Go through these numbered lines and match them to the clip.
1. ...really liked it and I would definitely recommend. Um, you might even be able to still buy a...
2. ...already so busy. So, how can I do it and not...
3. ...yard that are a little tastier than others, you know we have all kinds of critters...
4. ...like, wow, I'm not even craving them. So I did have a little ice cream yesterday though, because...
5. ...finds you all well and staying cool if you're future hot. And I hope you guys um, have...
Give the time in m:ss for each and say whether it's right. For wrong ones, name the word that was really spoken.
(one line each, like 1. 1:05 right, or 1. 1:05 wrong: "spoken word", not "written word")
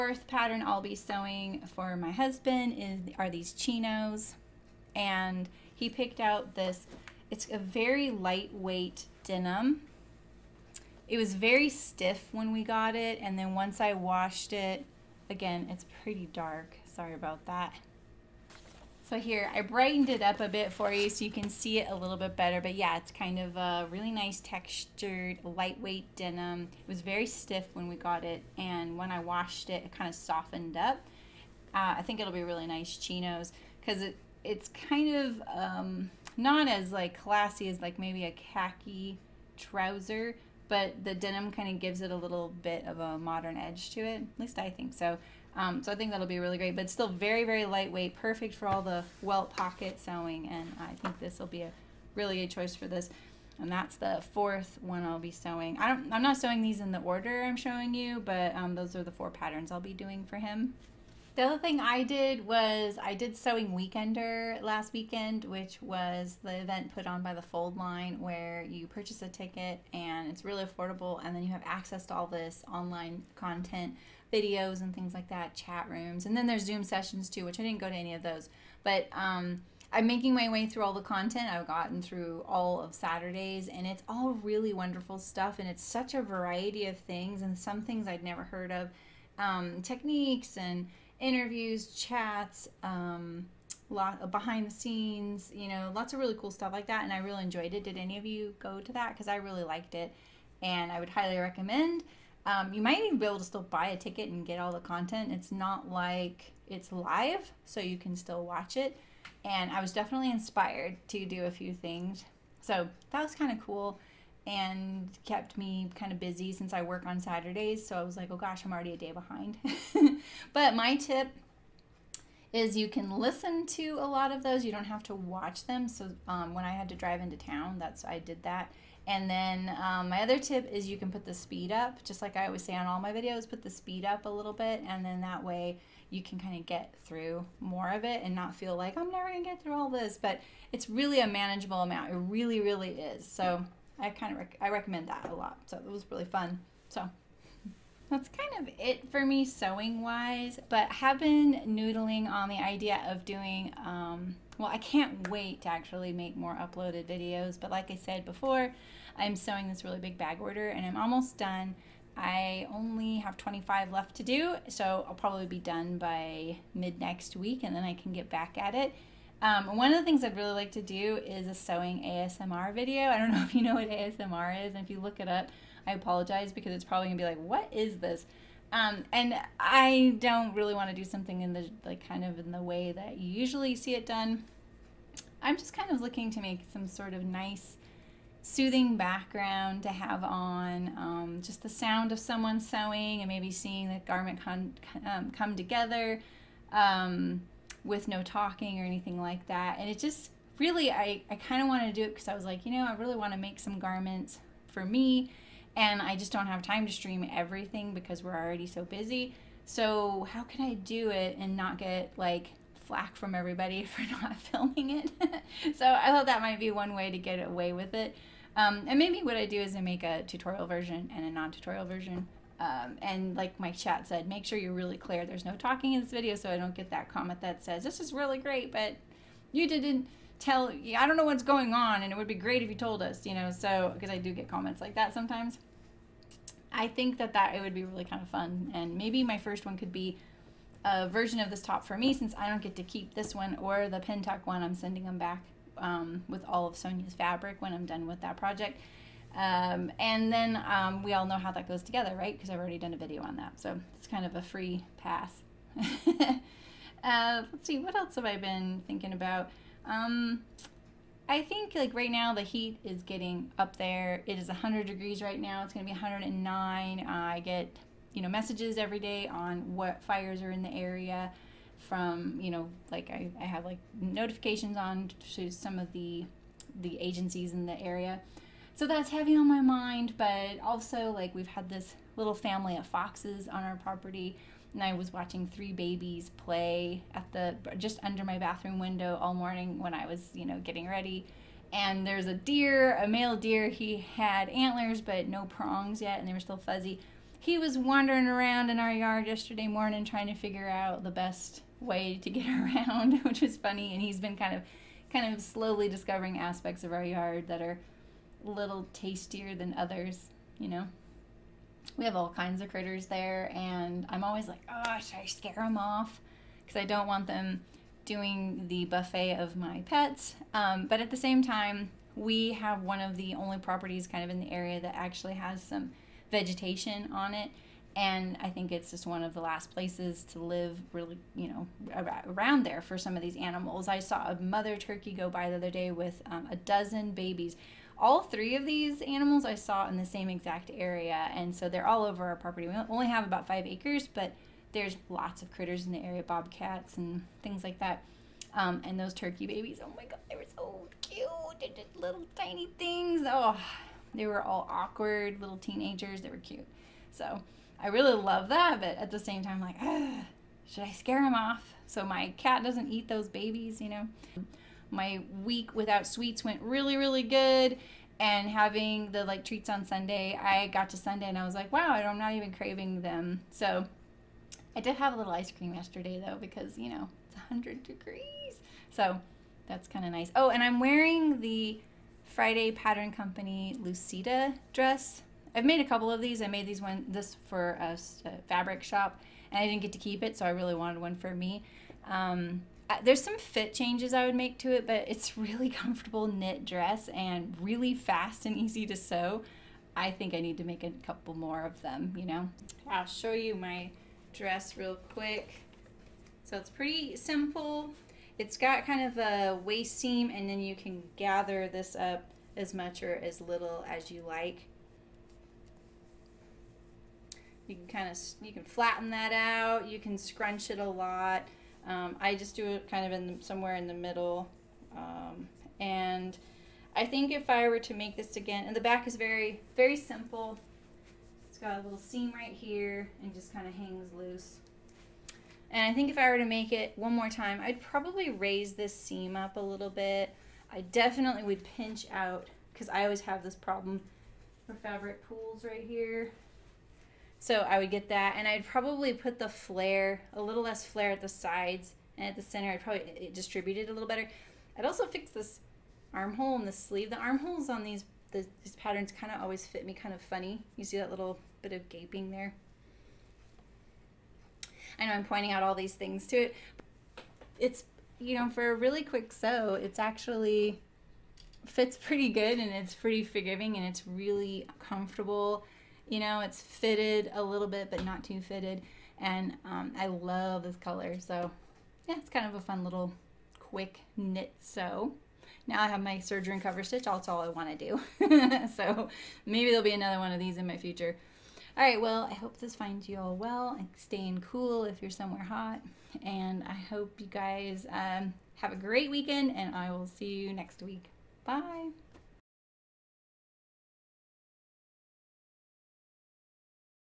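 1. 1:39 wrong: "highly", not "definitely"
2. 3:28 right
3. 5:07 right
4. 6:11 right
5. 8:12 wrong: "somewhere", not "future".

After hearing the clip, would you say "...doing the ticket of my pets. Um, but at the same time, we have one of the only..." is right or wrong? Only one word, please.
wrong.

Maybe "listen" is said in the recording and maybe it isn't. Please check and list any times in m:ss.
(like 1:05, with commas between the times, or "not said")
2:03.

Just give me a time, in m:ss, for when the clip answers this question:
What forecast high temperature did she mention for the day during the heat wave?
4:25.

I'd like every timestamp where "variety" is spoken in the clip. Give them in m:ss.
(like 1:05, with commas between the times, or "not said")
1:26.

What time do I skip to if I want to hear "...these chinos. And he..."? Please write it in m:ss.
0:03.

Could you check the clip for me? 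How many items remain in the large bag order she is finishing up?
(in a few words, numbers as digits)
25.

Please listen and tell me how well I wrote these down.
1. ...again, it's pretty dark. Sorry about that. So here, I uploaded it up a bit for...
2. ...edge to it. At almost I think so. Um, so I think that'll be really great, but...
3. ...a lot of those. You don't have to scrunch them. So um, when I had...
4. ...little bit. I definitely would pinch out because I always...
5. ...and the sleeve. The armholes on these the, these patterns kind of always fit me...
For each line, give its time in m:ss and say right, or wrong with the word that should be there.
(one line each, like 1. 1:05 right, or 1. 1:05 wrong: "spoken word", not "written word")
1. 0:15 wrong: "brightened", not "uploaded"
2. 0:43 wrong: "least", not "almost"
3. 2:03 wrong: "watch", not "scrunch"
4. 7:19 right
5. 7:36 right.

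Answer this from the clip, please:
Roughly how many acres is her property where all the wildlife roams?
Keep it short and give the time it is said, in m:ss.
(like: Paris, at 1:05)
5, at 5:43.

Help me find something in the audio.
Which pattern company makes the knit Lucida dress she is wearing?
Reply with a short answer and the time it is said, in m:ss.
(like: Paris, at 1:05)
Friday Pattern Company, at 6:22.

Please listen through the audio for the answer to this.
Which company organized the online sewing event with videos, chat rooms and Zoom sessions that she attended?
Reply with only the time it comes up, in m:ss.
1:07.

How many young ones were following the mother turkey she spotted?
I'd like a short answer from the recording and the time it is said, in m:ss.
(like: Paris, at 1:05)
a dozen, at 5:36.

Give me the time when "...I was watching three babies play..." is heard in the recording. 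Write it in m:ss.
4:44.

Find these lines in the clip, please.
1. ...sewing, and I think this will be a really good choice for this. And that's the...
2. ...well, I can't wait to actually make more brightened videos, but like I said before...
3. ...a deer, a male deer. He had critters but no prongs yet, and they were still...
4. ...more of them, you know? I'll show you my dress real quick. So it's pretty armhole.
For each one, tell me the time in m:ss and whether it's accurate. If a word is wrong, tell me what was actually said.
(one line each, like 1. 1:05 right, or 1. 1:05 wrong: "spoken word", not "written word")
1. 0:50 right
2. 2:34 wrong: "uploaded", not "brightened"
3. 4:52 wrong: "antlers", not "critters"
4. 6:41 wrong: "simple", not "armhole".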